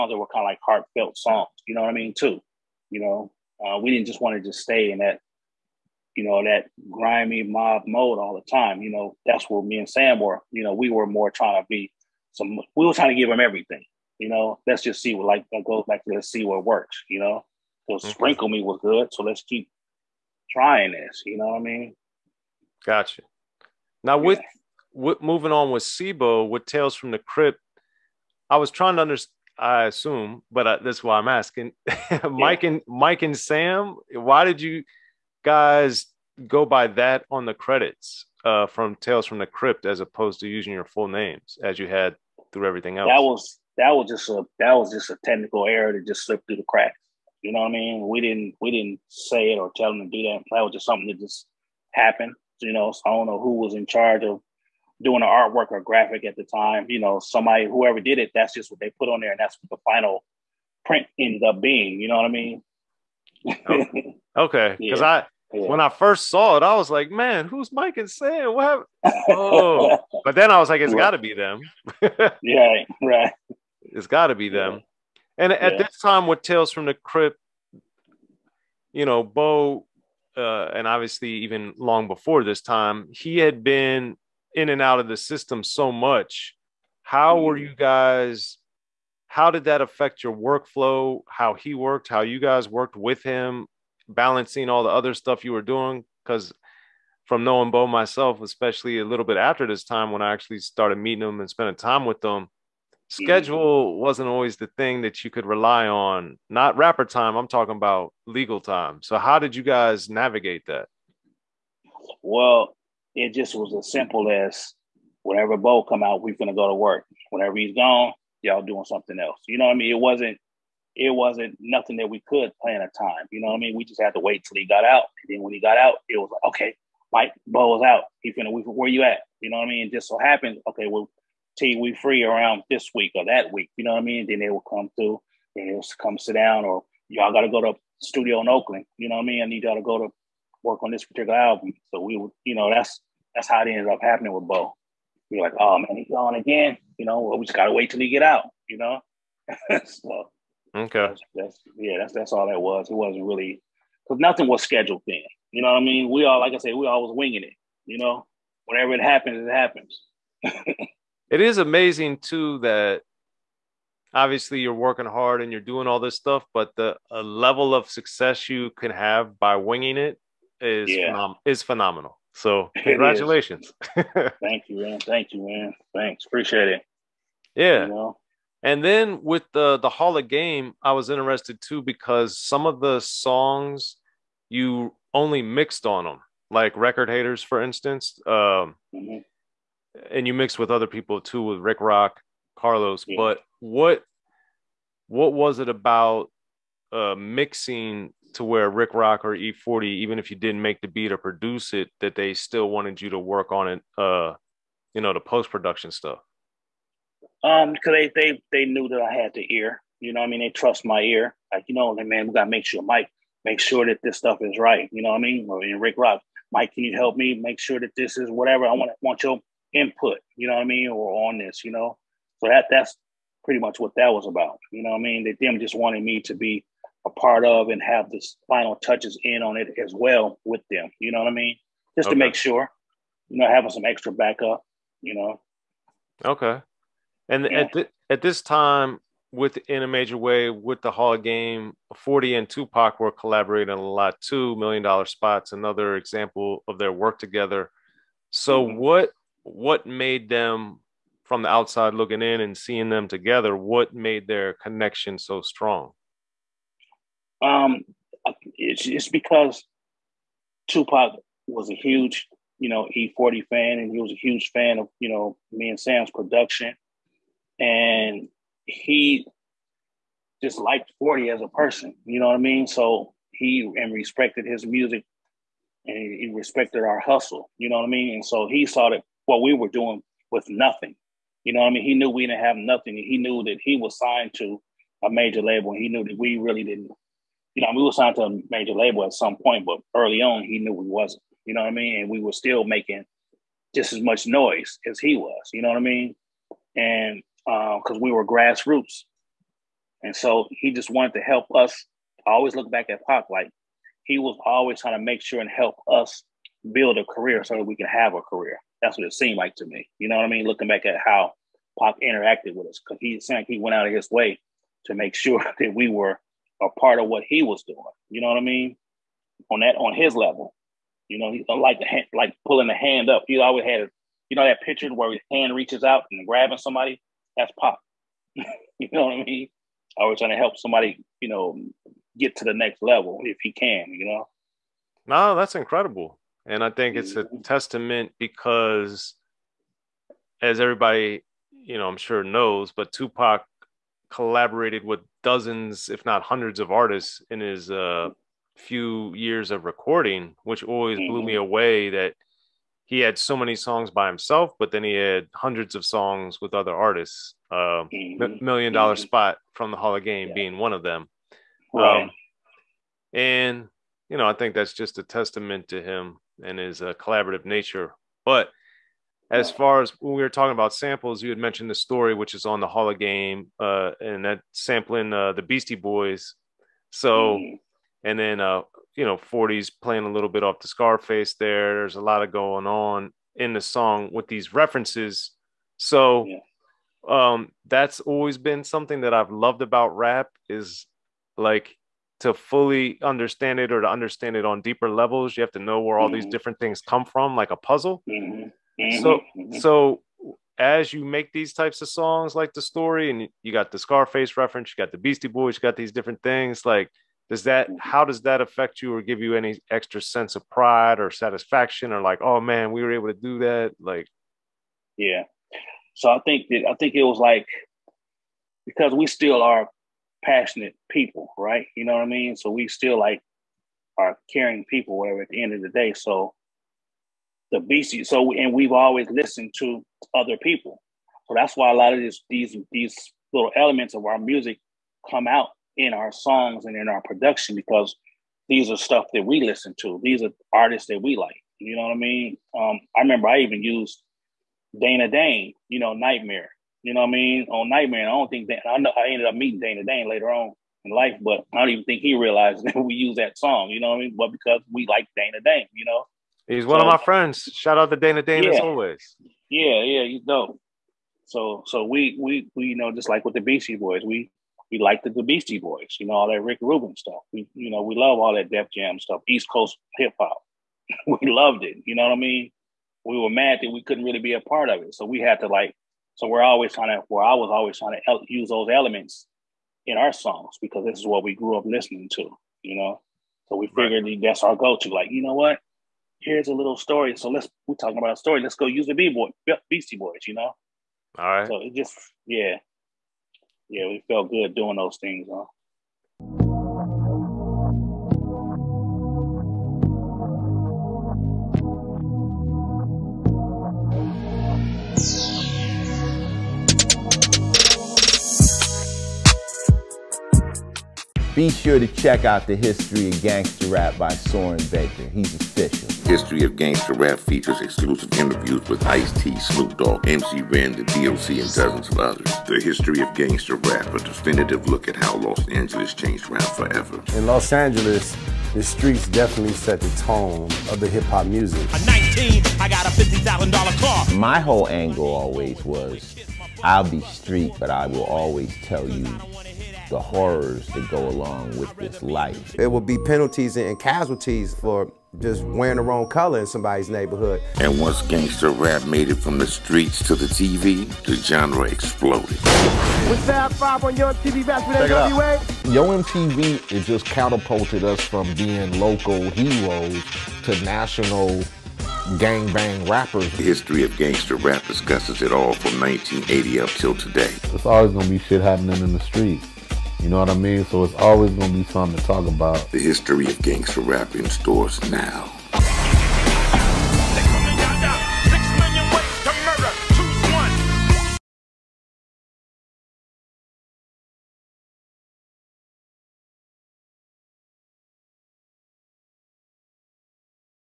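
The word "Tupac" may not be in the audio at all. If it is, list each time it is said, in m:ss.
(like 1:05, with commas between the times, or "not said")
4:02, 4:20, 5:42.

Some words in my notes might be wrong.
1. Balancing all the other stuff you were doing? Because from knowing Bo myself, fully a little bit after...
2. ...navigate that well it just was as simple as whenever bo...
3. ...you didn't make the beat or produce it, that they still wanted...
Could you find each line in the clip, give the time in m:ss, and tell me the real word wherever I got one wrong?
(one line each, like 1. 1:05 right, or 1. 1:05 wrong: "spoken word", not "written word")
1. 1:34 wrong: "especially", not "fully"
2. 1:50 right
3. 3:20 right.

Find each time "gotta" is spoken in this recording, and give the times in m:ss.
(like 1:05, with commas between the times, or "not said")
2:27, 3:32.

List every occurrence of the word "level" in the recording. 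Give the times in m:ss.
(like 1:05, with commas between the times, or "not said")
2:47, 5:20, 5:32, 6:34.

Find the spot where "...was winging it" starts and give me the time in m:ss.
2:37.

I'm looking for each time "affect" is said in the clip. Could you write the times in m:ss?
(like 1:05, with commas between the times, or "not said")
1:29, 6:48.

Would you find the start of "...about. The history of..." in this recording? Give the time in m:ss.
9:32.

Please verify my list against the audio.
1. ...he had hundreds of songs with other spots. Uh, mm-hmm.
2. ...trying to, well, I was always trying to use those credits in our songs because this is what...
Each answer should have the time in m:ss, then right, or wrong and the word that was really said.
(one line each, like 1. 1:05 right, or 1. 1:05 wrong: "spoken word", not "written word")
1. 5:54 wrong: "artists", not "spots"
2. 7:56 wrong: "elements", not "credits".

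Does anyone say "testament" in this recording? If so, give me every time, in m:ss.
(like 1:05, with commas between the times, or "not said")
5:37, 6:05.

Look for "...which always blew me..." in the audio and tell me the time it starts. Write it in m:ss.
5:50.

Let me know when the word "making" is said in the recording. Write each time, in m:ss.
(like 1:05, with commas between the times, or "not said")
4:52.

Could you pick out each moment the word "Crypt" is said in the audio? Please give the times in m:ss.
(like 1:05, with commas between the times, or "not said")
0:27, 0:39, 1:16.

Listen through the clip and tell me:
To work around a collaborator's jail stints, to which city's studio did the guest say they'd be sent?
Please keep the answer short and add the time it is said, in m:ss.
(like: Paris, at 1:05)
Oakland, at 2:18.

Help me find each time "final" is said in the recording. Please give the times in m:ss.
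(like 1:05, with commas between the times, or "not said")
0:59, 3:48.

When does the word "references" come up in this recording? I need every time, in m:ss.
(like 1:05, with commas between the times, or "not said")
6:24, 6:44.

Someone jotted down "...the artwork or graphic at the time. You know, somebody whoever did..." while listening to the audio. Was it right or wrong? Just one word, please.
right.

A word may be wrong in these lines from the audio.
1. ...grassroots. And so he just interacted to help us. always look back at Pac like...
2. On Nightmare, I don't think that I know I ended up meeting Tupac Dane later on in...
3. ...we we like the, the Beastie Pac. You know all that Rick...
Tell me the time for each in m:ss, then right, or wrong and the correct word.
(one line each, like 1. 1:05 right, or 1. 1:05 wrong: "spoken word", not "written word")
1. 4:58 wrong: "wanted", not "interacted"
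2. 7:27 wrong: "Dana", not "Tupac"
3. 7:44 wrong: "Boys", not "Pac".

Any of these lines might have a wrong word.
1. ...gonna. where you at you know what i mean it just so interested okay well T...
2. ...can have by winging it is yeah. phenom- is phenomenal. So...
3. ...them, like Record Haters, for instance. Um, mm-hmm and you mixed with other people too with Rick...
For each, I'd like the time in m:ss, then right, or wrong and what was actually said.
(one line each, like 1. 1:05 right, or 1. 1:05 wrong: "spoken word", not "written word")
1. 2:08 wrong: "happened", not "interested"
2. 2:48 right
3. 3:06 right.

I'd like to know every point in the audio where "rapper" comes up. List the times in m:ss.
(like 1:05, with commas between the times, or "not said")
1:46, 9:22.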